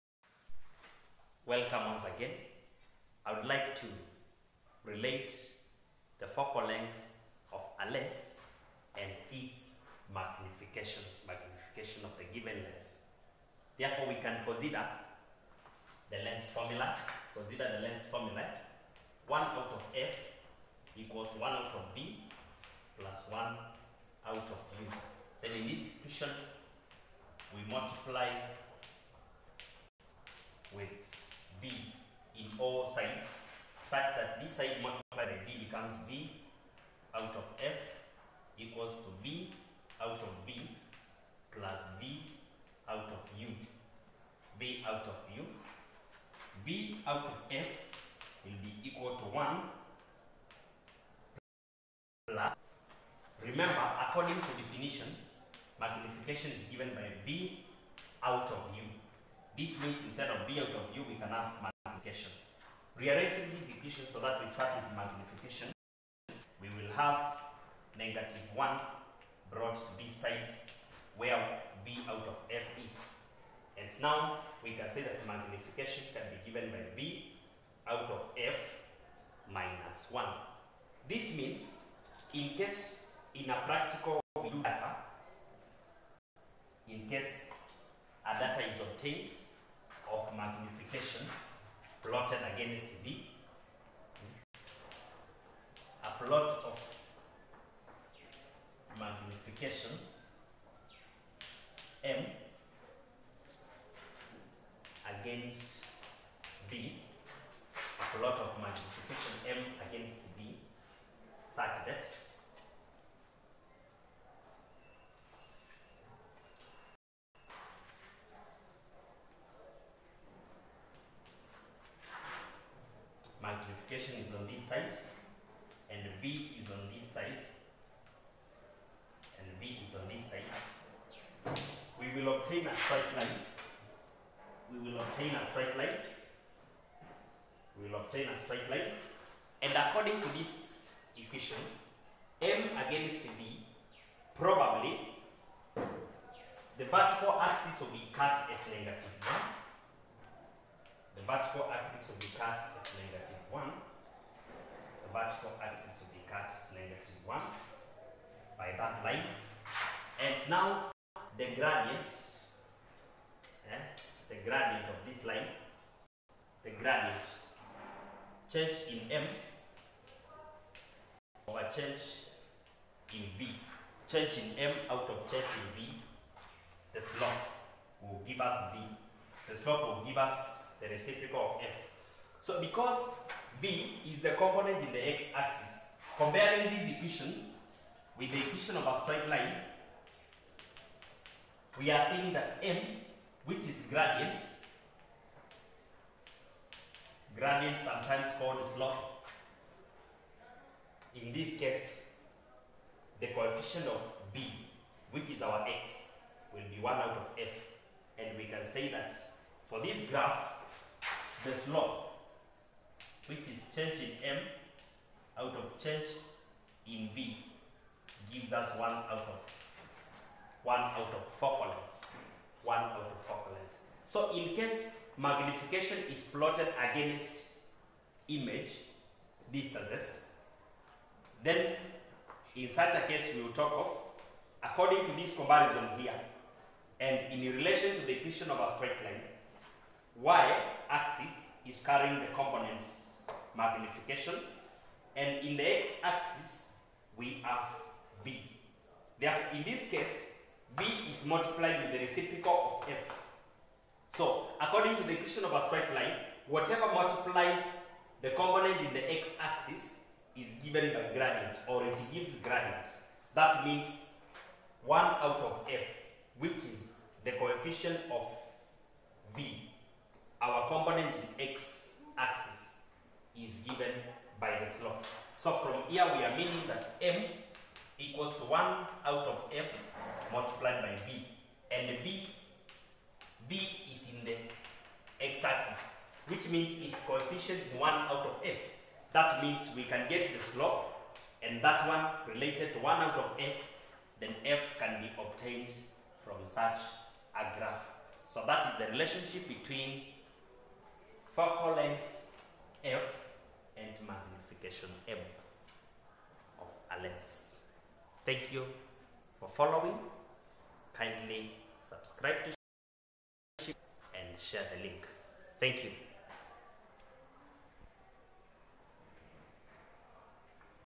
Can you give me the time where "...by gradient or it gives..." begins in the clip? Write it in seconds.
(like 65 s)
260 s.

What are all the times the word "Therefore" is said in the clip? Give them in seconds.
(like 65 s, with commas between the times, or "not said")
13 s, 249 s.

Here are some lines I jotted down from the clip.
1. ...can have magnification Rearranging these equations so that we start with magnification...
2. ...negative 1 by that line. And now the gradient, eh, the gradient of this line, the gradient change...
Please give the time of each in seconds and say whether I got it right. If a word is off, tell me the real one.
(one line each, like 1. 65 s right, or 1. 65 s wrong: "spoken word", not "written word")
1. 61 s right
2. 156 s right.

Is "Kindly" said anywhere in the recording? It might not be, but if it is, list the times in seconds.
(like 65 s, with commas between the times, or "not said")
310 s.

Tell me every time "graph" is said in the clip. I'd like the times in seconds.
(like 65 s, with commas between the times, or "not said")
210 s, 297 s.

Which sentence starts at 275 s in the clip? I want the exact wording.
So from here we are meaning that m equals to 1 out of f multiplied by v.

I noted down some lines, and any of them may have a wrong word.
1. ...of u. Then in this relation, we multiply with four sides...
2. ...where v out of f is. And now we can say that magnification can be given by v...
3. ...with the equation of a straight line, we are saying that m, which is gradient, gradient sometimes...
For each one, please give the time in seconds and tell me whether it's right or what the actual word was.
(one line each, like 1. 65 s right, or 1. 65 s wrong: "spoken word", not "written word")
1. 24 s wrong: "equation", not "relation"
2. 71 s right
3. 188 s right.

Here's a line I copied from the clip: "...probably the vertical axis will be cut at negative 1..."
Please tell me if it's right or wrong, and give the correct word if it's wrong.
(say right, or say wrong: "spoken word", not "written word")
right.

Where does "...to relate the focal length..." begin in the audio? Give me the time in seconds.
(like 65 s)
3 s.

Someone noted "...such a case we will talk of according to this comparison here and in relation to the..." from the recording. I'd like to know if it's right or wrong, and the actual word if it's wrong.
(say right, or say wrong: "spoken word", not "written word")
right.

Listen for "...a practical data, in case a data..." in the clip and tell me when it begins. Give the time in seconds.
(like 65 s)
83 s.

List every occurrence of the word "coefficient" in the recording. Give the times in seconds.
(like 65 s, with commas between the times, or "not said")
203 s, 267 s, 287 s.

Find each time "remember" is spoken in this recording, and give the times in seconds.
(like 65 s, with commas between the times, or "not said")
53 s.